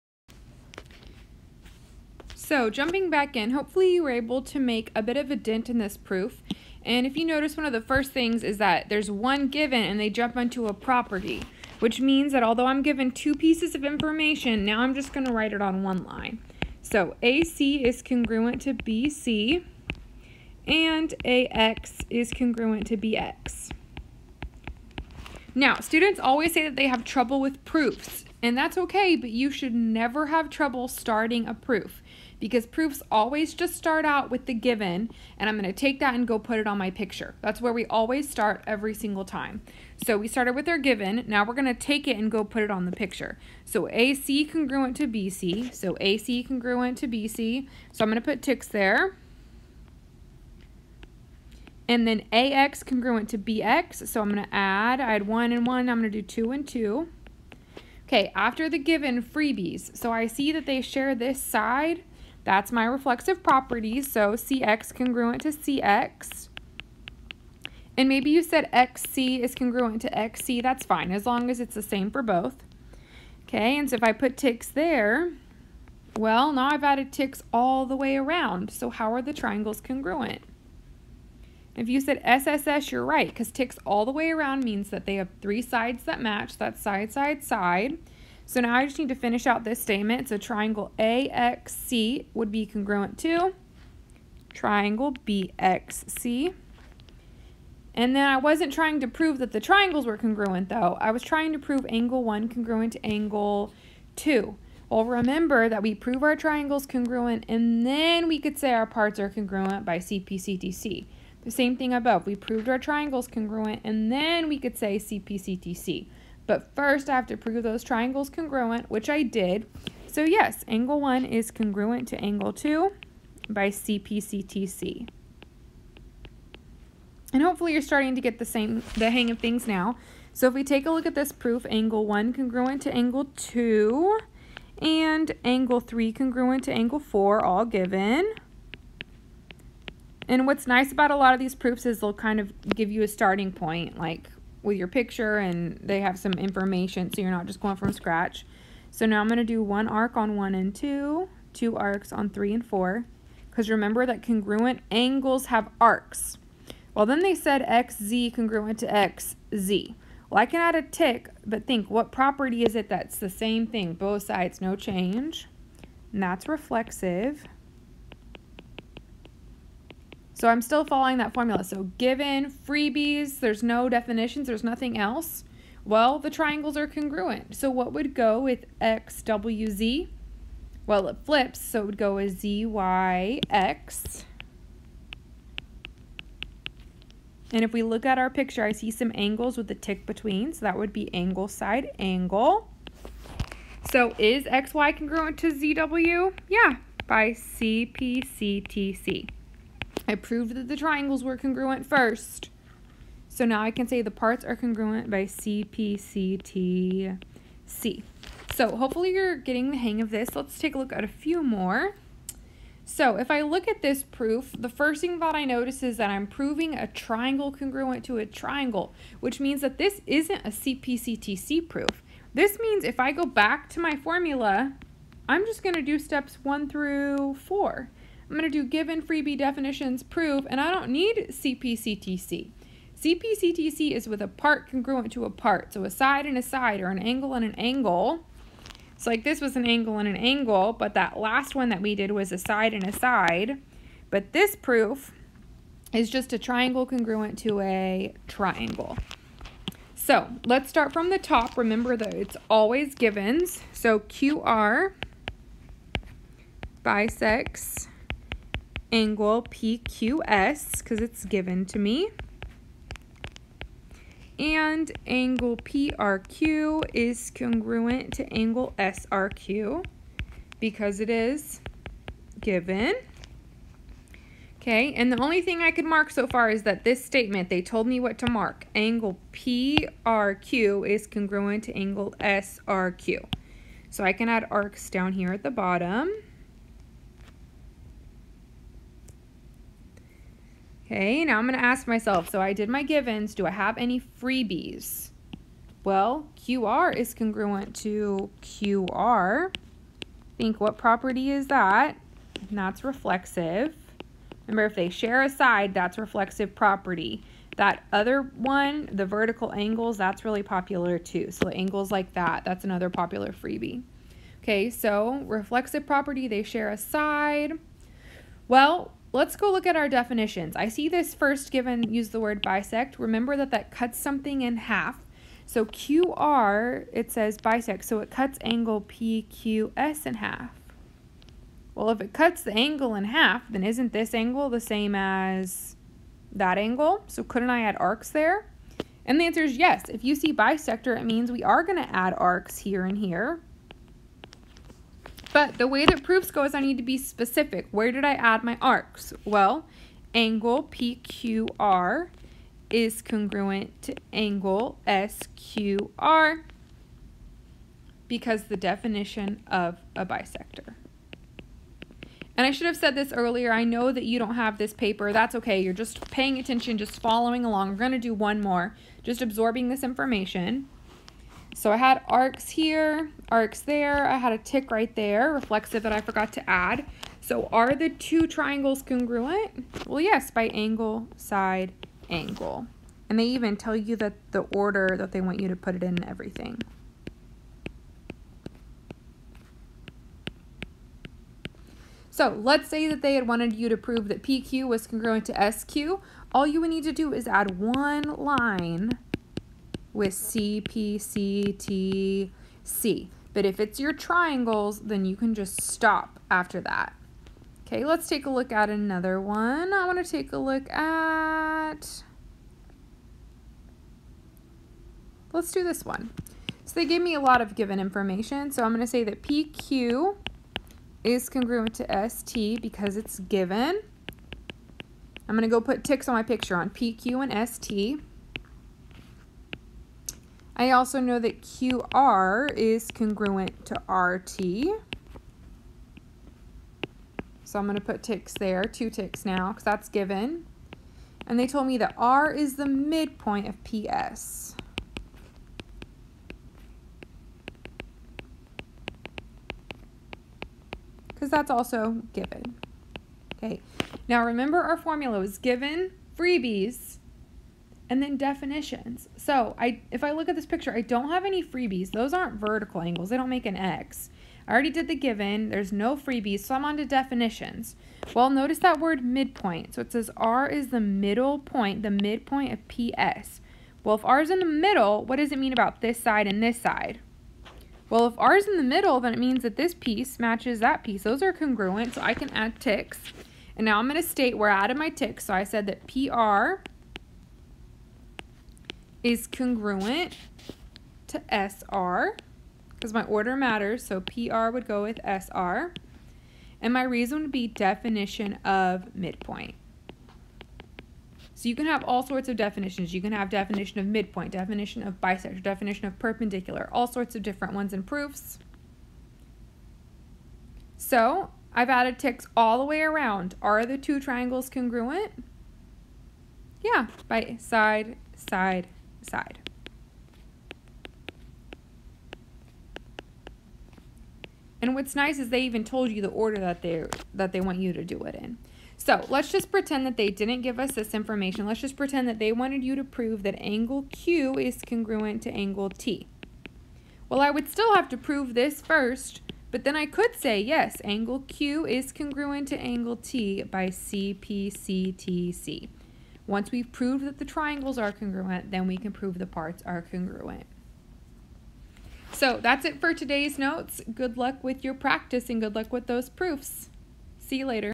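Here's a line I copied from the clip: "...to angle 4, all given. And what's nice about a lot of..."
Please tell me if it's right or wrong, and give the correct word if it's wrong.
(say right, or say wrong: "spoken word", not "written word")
right.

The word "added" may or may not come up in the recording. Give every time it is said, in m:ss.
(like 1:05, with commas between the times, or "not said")
1:16, 8:04, 8:31.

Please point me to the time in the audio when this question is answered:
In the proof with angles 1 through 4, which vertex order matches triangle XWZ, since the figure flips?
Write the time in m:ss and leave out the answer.
3:02.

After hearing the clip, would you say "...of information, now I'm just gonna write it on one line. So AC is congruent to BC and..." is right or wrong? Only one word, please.
right.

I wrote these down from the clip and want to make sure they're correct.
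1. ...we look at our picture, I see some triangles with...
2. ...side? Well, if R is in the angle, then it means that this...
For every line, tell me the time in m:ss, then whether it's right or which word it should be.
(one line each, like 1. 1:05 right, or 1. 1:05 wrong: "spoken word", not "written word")
1. 3:07 wrong: "angles", not "triangles"
2. 7:56 wrong: "middle", not "angle".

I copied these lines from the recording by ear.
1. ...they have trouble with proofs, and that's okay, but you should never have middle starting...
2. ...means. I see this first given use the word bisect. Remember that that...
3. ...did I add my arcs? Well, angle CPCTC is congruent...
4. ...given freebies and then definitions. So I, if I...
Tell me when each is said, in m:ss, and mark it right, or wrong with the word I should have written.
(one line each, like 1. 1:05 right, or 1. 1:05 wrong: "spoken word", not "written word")
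1. 0:26 wrong: "trouble", not "middle"
2. 5:19 wrong: "definitions", not "means"
3. 5:47 wrong: "PQR", not "CPCTC"
4. 7:35 right.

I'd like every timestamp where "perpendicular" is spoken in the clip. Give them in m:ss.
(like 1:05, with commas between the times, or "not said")
8:25.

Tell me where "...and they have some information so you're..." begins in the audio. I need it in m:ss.
2:25.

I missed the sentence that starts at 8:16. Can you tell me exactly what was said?
And my reason would be definition of midpoint.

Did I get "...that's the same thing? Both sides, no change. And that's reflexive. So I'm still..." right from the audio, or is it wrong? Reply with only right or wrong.
right.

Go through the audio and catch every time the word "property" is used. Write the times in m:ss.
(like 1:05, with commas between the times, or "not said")
0:10, 1:03, 2:42, 5:00, 5:06, 5:15.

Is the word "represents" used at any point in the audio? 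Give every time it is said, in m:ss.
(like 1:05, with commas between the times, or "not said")
not said.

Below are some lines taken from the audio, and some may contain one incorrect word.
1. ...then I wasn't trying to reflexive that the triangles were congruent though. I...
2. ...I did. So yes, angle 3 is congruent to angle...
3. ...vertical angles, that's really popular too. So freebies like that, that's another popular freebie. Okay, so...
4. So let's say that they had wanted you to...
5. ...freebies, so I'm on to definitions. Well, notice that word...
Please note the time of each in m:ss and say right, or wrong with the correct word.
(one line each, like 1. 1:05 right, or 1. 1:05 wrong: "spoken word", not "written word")
1. 1:38 wrong: "prove", not "reflexive"
2. 1:59 wrong: "1", not "3"
3. 5:09 wrong: "angles", not "freebies"
4. 6:32 right
5. 7:45 right.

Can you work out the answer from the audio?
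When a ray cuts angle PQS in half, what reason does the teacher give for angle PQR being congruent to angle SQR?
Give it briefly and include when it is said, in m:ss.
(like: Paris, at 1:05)
Definition of a bisector, at 5:58.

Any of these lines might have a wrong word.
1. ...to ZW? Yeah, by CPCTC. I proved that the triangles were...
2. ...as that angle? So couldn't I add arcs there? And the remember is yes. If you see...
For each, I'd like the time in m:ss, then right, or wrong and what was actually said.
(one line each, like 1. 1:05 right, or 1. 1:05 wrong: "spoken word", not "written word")
1. 3:15 right
2. 5:34 wrong: "answer", not "remember".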